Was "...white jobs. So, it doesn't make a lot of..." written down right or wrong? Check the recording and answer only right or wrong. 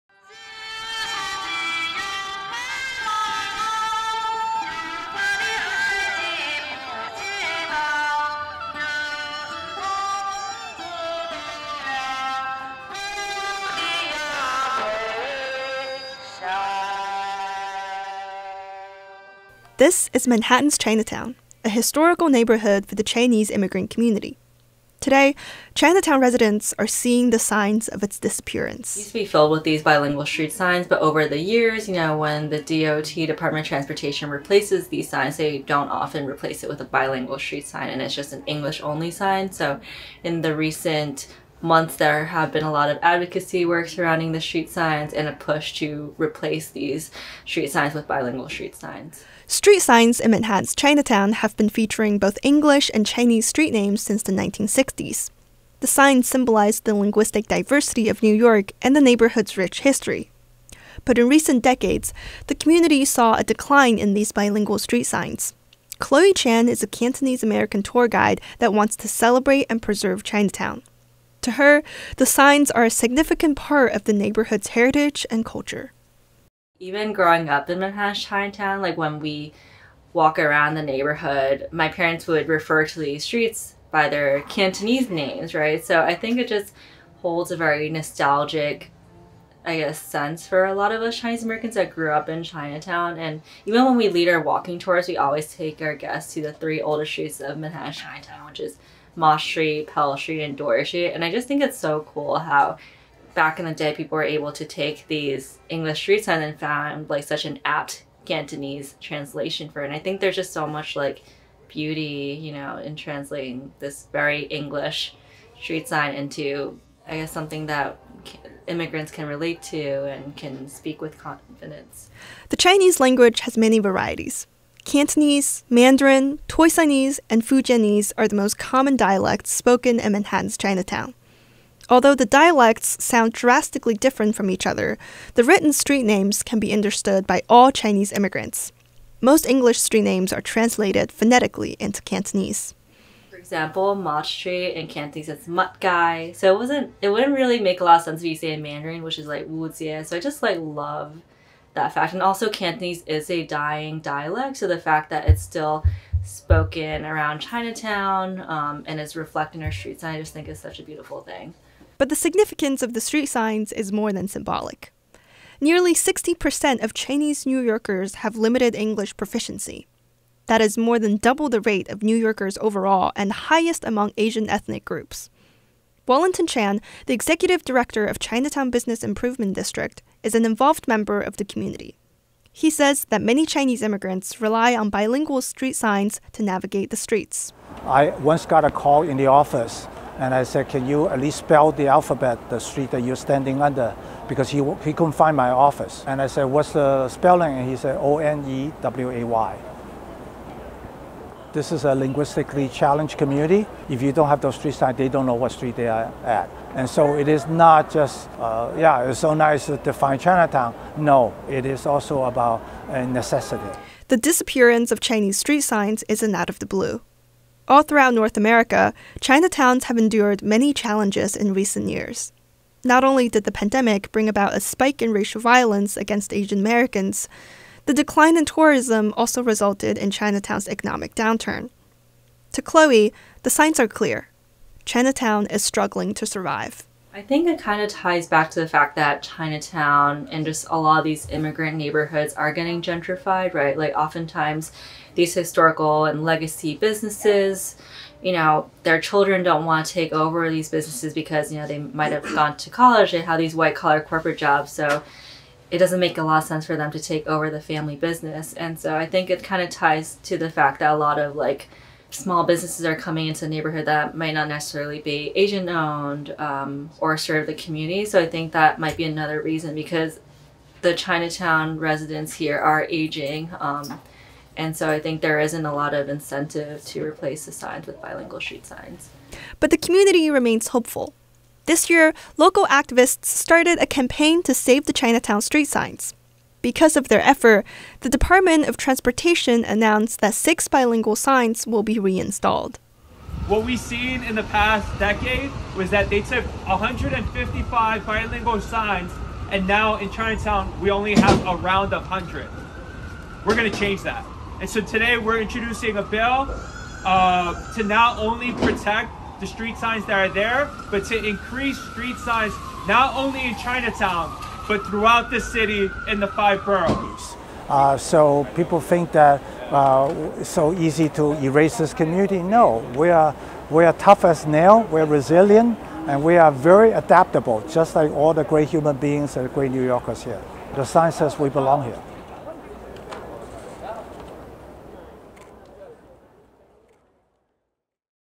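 wrong.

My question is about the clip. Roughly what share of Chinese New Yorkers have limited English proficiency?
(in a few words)
60%.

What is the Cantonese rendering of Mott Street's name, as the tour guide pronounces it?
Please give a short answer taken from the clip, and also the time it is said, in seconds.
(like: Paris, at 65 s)
Mutt Guy, at 145 s.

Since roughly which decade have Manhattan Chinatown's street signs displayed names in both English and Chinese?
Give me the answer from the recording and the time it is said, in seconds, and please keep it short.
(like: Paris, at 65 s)
1960s, at 54 s.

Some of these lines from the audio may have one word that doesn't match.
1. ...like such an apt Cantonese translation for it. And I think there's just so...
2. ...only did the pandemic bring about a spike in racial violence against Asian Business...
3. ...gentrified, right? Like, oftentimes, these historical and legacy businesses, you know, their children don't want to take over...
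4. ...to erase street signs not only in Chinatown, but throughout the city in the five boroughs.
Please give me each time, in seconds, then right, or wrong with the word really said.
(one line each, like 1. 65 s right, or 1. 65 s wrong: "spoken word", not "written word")
1. 107 s right
2. 223 s wrong: "Americans", not "Business"
3. 242 s right
4. 311 s wrong: "increase", not "erase".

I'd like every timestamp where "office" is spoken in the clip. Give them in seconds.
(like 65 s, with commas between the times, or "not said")
189 s, 195 s.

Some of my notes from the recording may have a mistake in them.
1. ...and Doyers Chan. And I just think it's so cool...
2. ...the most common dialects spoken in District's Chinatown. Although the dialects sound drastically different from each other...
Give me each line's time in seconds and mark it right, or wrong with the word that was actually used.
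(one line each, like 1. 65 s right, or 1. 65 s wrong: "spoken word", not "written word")
1. 100 s wrong: "Street", not "Chan"
2. 128 s wrong: "Manhattan", not "District".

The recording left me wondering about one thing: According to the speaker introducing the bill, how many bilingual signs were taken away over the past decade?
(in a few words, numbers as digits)
155.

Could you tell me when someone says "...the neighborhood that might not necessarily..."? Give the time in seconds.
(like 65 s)
263 s.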